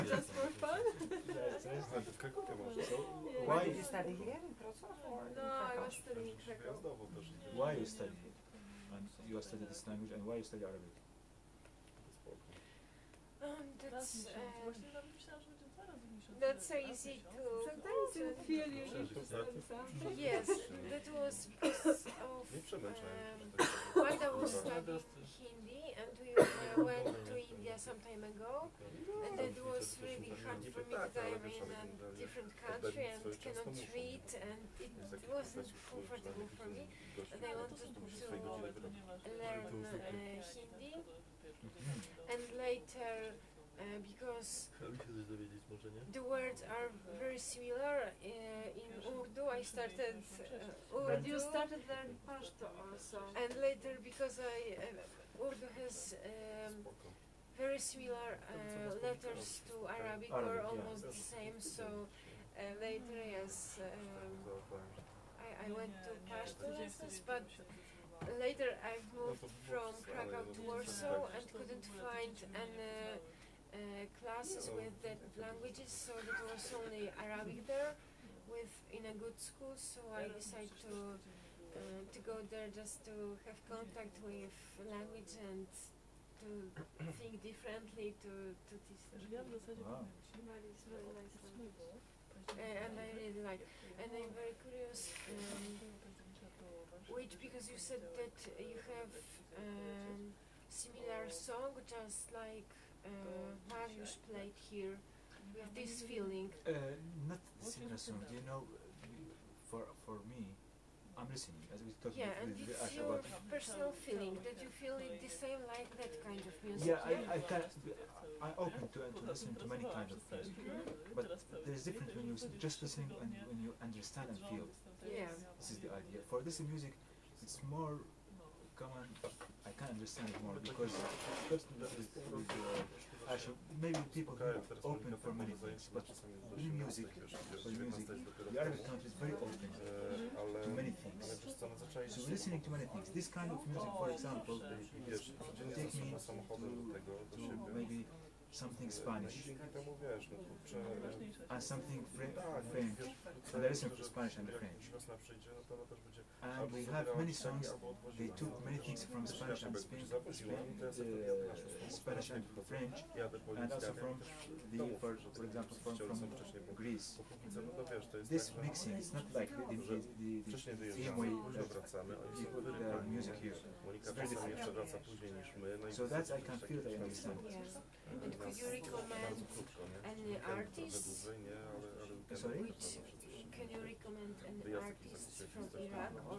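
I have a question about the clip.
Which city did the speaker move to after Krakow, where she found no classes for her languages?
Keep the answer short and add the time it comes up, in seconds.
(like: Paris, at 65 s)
Warsaw, at 70 s.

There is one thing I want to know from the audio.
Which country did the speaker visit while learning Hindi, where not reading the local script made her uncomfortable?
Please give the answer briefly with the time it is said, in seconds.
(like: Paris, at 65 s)
India, at 27 s.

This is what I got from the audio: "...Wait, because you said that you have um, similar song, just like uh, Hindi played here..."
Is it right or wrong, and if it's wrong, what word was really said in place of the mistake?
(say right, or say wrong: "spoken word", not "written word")
wrong: "Mariusz", not "Hindi".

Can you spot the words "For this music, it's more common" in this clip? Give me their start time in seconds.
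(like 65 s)
126 s.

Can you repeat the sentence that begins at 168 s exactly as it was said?
This mixing is not like the, the, the, the same way that people about music here.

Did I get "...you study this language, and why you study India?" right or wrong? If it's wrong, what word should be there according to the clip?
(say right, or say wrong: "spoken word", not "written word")
wrong: "Arabic", not "India".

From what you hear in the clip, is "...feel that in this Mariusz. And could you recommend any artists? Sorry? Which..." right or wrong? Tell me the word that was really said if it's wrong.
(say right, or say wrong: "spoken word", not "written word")
wrong: "Yeah", not "Mariusz".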